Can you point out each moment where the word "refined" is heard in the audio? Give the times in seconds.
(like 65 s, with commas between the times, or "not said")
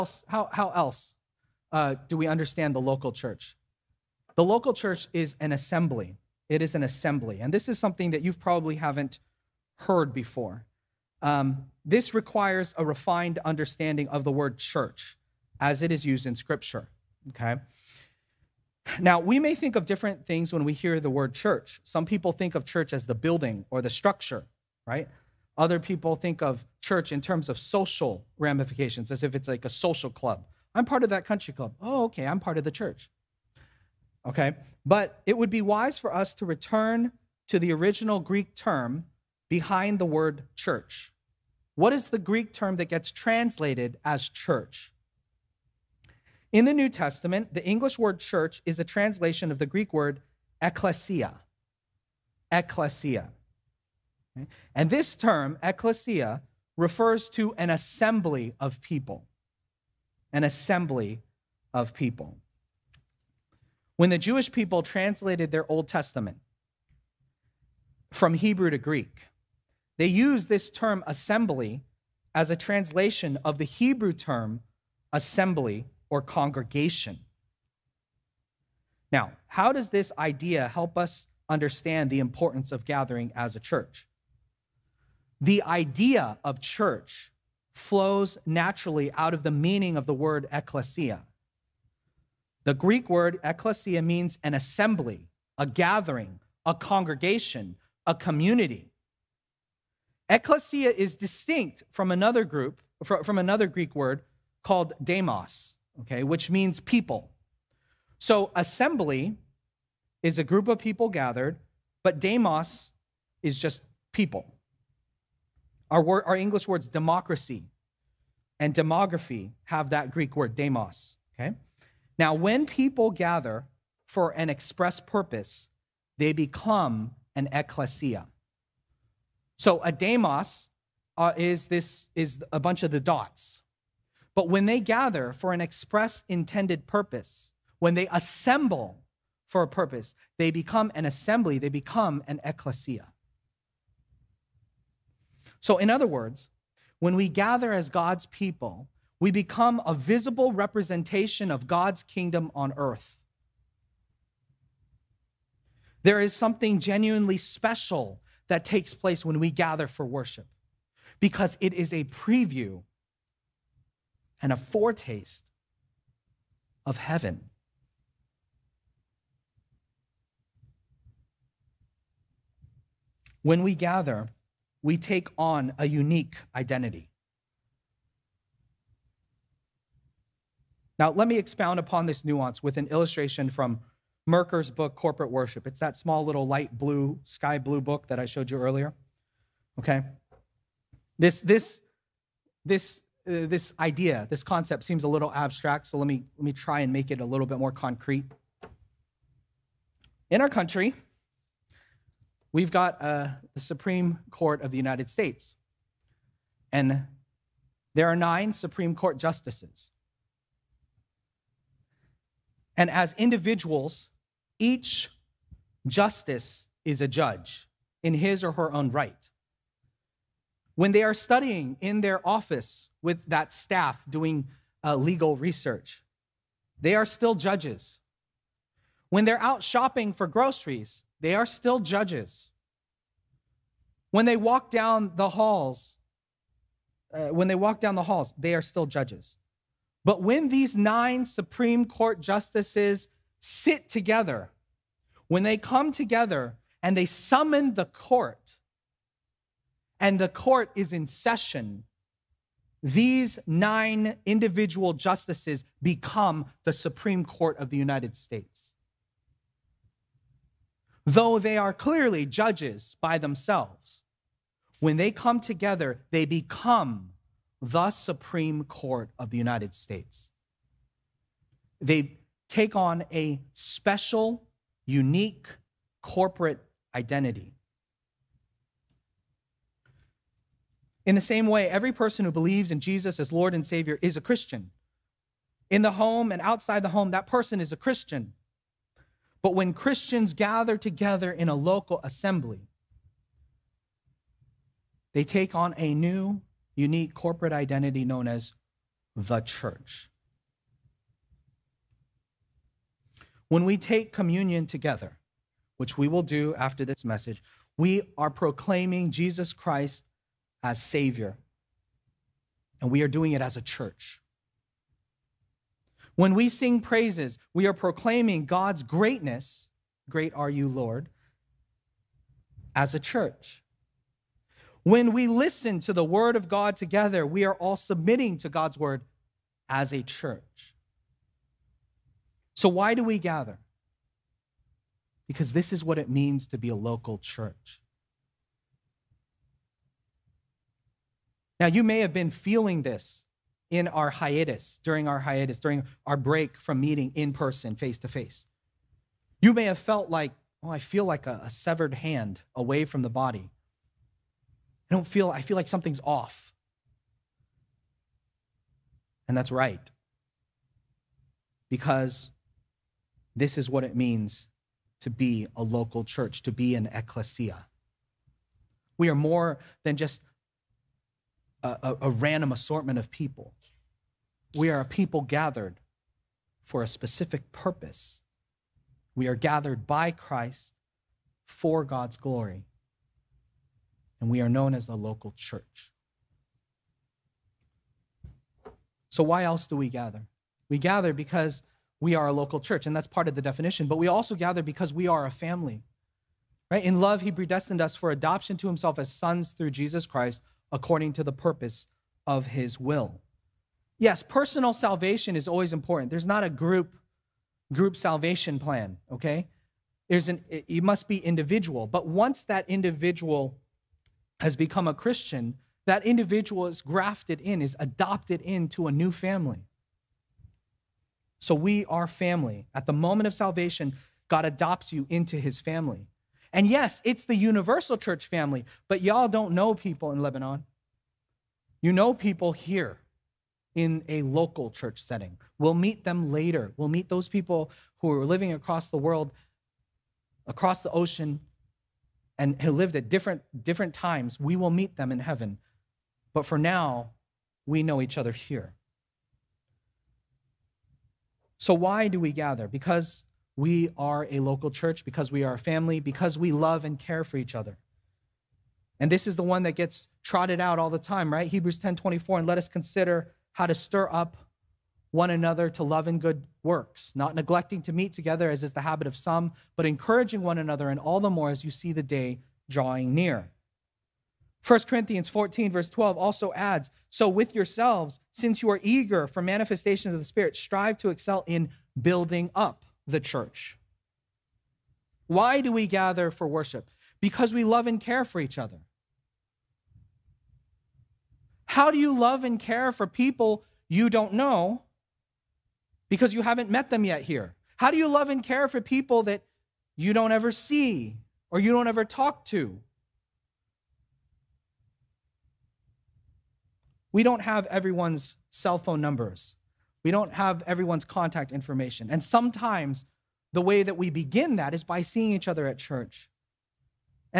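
12 s.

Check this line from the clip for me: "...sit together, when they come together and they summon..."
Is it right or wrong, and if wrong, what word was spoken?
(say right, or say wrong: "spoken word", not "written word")
right.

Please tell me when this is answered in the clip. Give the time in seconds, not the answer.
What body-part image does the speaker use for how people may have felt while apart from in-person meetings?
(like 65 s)
351 s.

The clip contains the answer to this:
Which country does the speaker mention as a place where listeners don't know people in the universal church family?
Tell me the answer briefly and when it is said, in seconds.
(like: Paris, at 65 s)
Lebanon, at 430 s.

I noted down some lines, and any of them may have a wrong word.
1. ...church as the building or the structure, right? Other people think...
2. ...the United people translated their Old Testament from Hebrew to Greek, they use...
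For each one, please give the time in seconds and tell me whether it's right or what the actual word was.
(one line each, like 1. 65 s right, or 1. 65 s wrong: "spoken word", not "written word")
1. 22 s right
2. 64 s wrong: "Jewish", not "United".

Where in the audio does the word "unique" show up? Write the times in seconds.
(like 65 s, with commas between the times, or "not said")
175 s, 274 s, 296 s.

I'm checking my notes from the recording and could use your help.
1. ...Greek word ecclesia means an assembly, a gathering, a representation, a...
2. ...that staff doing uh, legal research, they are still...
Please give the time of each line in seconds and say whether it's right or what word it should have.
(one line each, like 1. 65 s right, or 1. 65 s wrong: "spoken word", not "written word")
1. 92 s wrong: "congregation", not "representation"
2. 223 s right.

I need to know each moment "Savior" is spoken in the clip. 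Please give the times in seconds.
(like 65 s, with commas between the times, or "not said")
283 s, 310 s.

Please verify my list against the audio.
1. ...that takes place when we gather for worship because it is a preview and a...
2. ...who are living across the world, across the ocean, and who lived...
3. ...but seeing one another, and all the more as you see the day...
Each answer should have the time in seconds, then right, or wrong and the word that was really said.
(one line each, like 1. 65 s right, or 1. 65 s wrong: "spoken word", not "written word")
1. 158 s right
2. 437 s right
3. 469 s wrong: "encouraging", not "seeing".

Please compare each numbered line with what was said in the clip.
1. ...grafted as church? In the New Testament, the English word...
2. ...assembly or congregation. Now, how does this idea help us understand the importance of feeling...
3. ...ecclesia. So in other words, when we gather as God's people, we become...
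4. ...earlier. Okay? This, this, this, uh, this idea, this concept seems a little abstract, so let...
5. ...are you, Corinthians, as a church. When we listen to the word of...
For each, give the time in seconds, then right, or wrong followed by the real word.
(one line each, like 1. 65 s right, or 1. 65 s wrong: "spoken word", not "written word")
1. 43 s wrong: "translated", not "grafted"
2. 75 s wrong: "gathering", not "feeling"
3. 142 s right
4. 188 s right
5. 320 s wrong: "Lord", not "Corinthians".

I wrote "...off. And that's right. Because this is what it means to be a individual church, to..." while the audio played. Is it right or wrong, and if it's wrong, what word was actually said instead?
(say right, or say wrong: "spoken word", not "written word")
wrong: "local", not "individual".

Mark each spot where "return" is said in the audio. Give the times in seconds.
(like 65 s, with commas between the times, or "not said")
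36 s.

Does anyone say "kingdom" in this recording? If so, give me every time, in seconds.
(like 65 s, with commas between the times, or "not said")
152 s.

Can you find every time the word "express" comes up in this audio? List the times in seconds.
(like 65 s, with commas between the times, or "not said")
124 s, 135 s.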